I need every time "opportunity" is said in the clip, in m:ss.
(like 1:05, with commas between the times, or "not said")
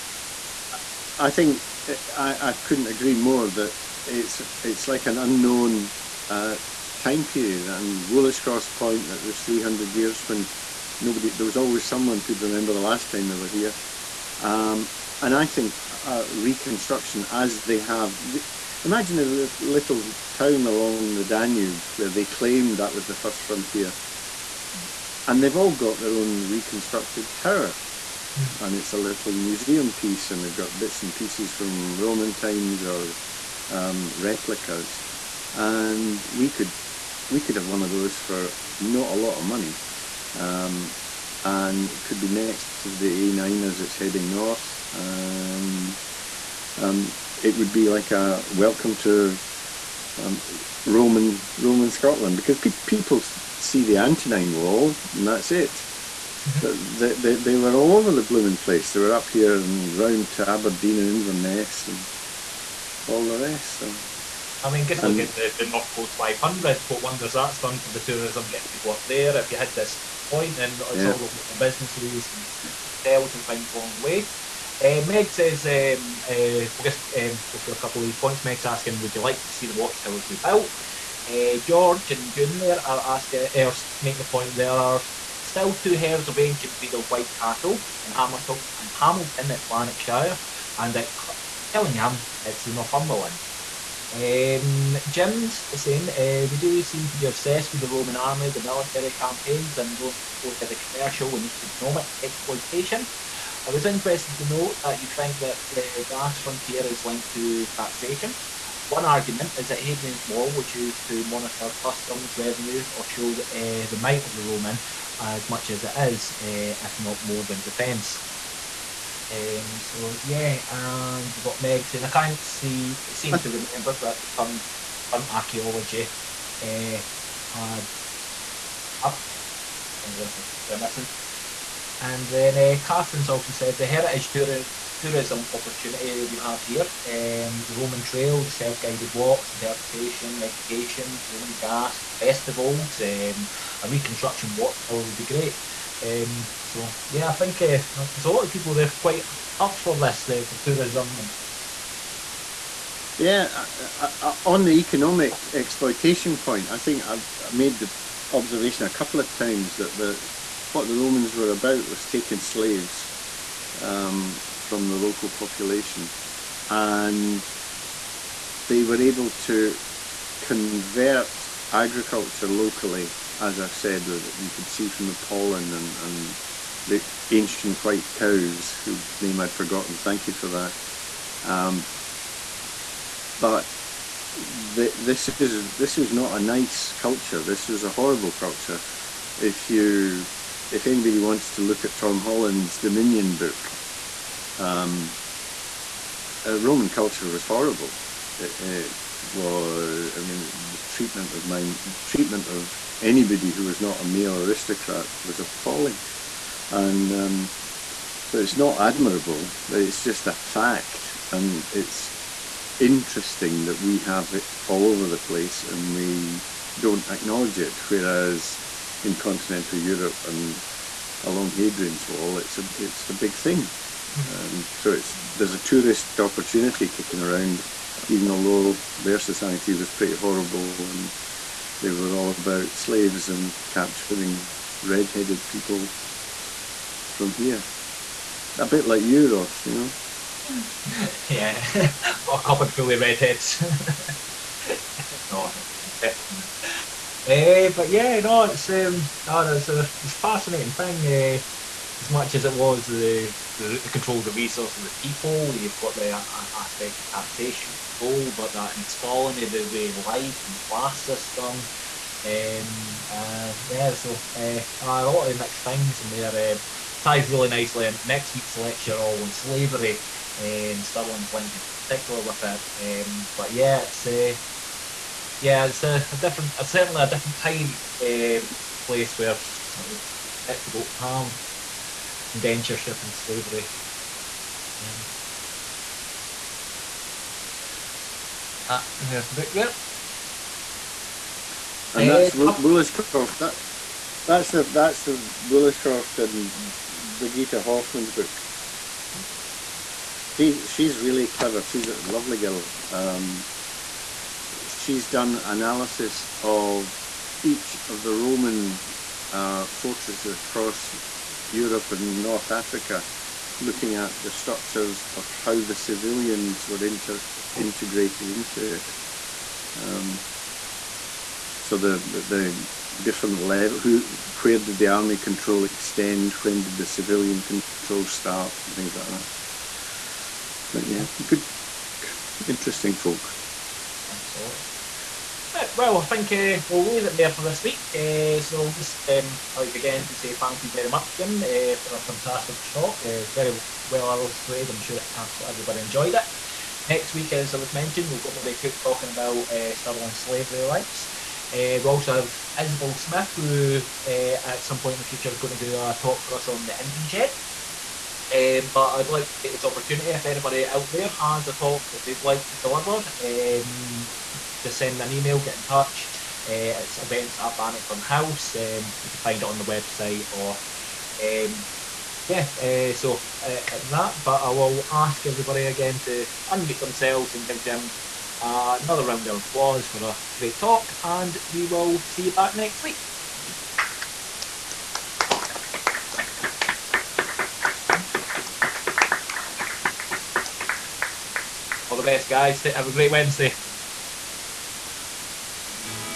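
2:15, 3:46, 5:59.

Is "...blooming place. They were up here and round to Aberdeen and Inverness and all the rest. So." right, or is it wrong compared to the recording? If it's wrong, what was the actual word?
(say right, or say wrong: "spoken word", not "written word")
right.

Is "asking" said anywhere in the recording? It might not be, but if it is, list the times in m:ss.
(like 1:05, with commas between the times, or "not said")
1:18, 1:23.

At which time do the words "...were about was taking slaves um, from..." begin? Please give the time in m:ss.
2:41.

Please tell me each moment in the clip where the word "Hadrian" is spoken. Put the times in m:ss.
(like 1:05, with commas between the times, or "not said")
1:49, 3:41.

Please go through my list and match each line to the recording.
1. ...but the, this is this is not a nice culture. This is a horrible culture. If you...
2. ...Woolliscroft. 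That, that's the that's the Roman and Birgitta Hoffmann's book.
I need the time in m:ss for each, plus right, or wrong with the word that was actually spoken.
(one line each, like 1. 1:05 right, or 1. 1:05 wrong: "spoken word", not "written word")
1. 3:03 right
2. 4:52 wrong: "Woolliscroft", not "Roman".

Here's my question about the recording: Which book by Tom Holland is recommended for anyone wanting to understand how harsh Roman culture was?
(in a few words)
Dominion.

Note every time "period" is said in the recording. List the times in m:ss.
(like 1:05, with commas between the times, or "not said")
0:07.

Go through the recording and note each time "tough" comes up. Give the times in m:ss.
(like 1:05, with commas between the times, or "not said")
not said.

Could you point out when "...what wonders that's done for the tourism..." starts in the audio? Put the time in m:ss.
1:06.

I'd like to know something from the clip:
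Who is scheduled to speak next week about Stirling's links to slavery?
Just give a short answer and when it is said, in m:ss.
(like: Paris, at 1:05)
Murray Cook, at 5:48.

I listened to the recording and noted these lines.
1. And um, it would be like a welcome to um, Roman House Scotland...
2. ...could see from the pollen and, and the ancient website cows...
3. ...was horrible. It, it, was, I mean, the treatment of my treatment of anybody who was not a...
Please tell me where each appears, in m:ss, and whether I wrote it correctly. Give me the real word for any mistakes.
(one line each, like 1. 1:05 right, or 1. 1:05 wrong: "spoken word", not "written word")
1. 0:44 wrong: "Roman", not "House"
2. 2:54 wrong: "white", not "website"
3. 3:17 right.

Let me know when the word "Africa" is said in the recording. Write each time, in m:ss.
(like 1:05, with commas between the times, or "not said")
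5:12.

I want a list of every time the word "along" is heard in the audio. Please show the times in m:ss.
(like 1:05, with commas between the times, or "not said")
0:20, 1:13, 3:41.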